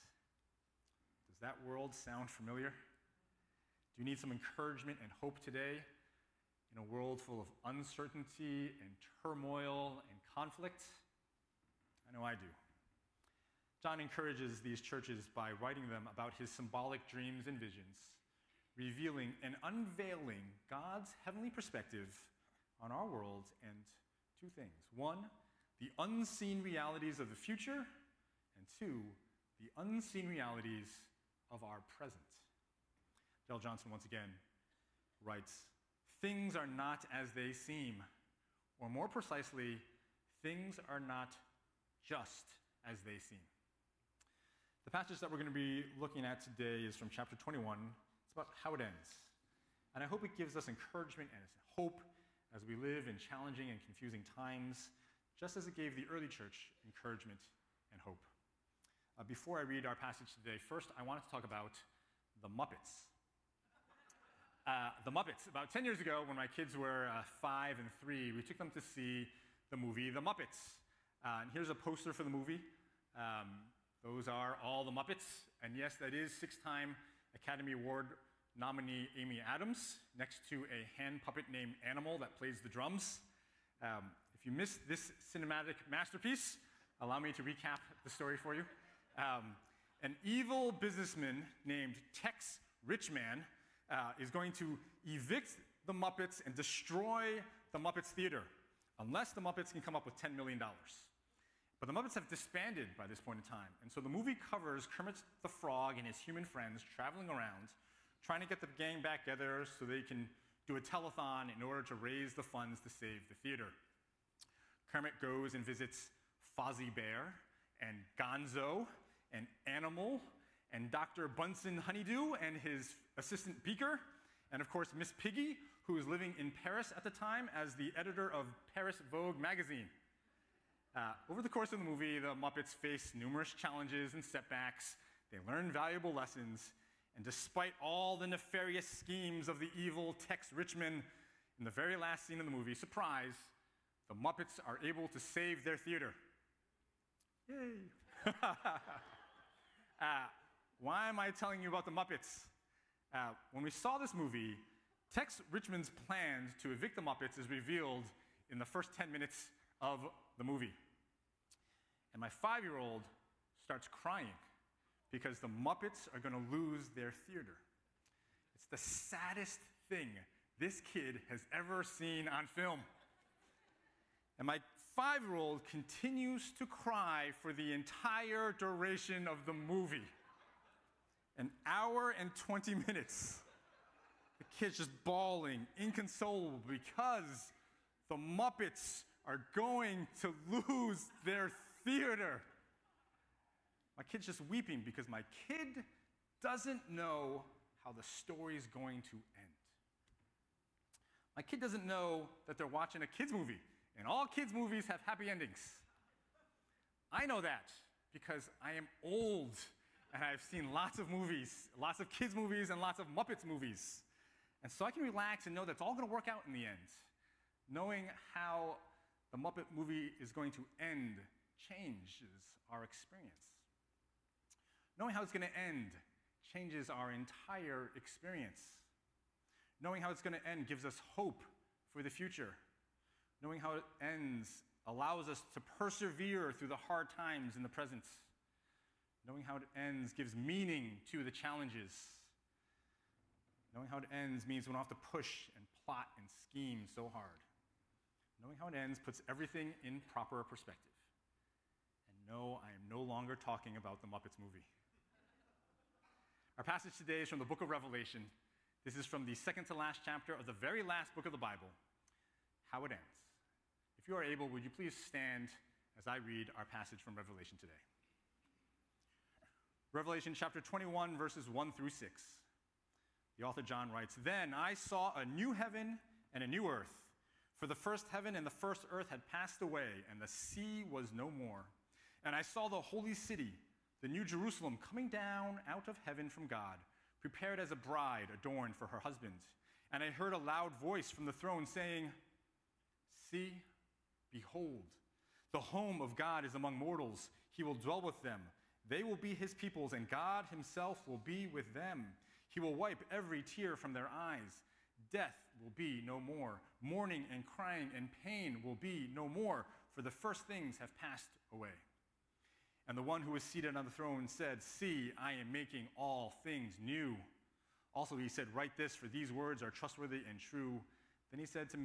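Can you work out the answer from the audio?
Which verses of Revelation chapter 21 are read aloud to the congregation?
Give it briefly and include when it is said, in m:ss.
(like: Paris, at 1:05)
1 through 6, at 4:31.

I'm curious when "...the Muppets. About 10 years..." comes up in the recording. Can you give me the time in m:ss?
1:05.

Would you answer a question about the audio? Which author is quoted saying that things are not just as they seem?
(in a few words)
Darrell Johnson.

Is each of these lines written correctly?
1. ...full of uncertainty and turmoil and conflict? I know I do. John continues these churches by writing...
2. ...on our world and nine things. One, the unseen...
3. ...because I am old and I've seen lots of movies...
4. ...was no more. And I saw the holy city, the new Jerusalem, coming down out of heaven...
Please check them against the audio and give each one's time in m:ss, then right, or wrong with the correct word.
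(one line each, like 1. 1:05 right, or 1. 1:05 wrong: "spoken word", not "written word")
1. 0:07 wrong: "encourages", not "continues"
2. 0:22 wrong: "two", not "nine"
3. 3:28 right
4. 4:40 right.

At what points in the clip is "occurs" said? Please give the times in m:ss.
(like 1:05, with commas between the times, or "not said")
not said.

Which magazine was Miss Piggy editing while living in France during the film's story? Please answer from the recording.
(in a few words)
Paris Vogue.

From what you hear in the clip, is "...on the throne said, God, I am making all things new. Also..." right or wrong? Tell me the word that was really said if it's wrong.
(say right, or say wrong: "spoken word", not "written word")
wrong: "See", not "God".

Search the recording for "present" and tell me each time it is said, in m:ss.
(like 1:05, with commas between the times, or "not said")
0:31, 3:57.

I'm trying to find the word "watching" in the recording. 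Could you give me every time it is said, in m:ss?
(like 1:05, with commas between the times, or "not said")
3:22.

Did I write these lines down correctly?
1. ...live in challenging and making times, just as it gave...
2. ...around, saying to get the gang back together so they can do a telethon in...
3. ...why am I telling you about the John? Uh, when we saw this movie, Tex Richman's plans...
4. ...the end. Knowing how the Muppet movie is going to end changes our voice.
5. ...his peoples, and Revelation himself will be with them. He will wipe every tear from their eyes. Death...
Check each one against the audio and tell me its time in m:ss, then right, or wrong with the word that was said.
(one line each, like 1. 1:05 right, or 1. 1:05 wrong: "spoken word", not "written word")
1. 0:52 wrong: "confusing", not "making"
2. 1:47 wrong: "trying", not "saying"
3. 2:30 wrong: "Muppets", not "John"
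4. 3:36 wrong: "experience", not "voice"
5. 4:59 wrong: "God", not "Revelation".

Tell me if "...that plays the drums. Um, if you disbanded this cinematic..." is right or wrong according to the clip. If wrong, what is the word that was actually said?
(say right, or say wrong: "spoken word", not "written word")
wrong: "missed", not "disbanded".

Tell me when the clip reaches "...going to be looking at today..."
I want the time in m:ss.
0:45.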